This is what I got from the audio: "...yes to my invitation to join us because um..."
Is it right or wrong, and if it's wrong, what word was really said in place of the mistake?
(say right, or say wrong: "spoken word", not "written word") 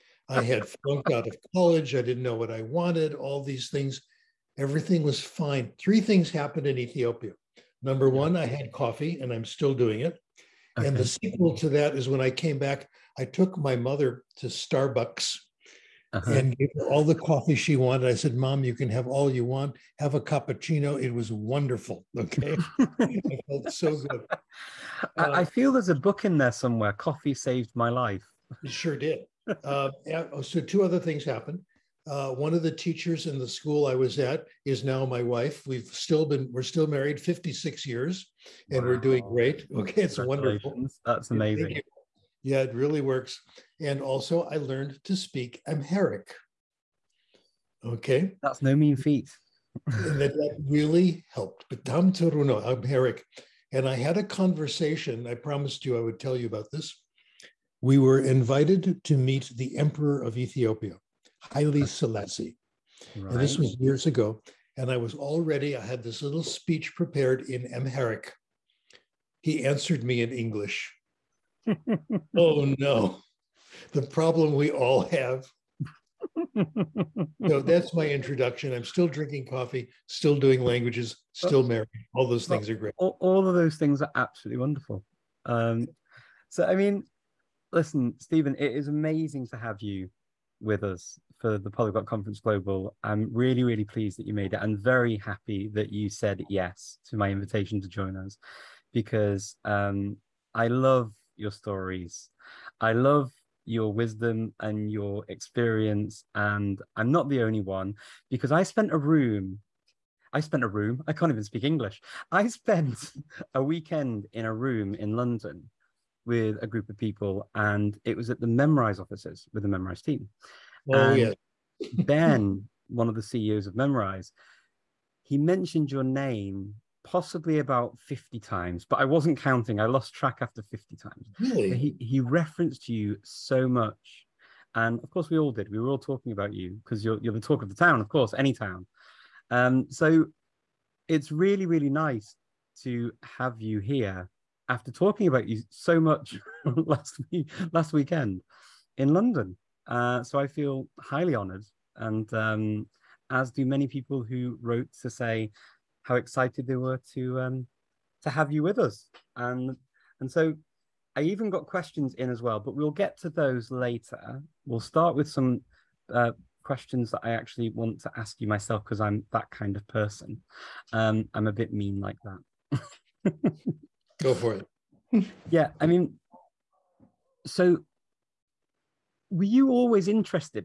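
right.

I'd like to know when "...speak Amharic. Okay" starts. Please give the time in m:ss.
0:45.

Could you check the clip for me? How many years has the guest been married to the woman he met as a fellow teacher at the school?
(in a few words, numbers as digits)
56.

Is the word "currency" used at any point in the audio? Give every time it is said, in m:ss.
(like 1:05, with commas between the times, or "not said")
not said.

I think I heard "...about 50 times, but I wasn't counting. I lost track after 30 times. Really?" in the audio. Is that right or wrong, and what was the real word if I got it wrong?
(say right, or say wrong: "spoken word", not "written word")
wrong: "50", not "30".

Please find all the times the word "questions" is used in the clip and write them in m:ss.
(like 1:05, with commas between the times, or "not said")
2:41, 2:46.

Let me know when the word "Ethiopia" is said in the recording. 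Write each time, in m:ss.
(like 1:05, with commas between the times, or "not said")
0:06, 1:00.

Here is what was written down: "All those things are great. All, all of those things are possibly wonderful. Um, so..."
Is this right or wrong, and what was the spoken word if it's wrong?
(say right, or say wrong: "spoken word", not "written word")
wrong: "absolutely", not "possibly".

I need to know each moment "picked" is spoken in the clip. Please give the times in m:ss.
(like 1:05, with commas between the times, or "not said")
not said.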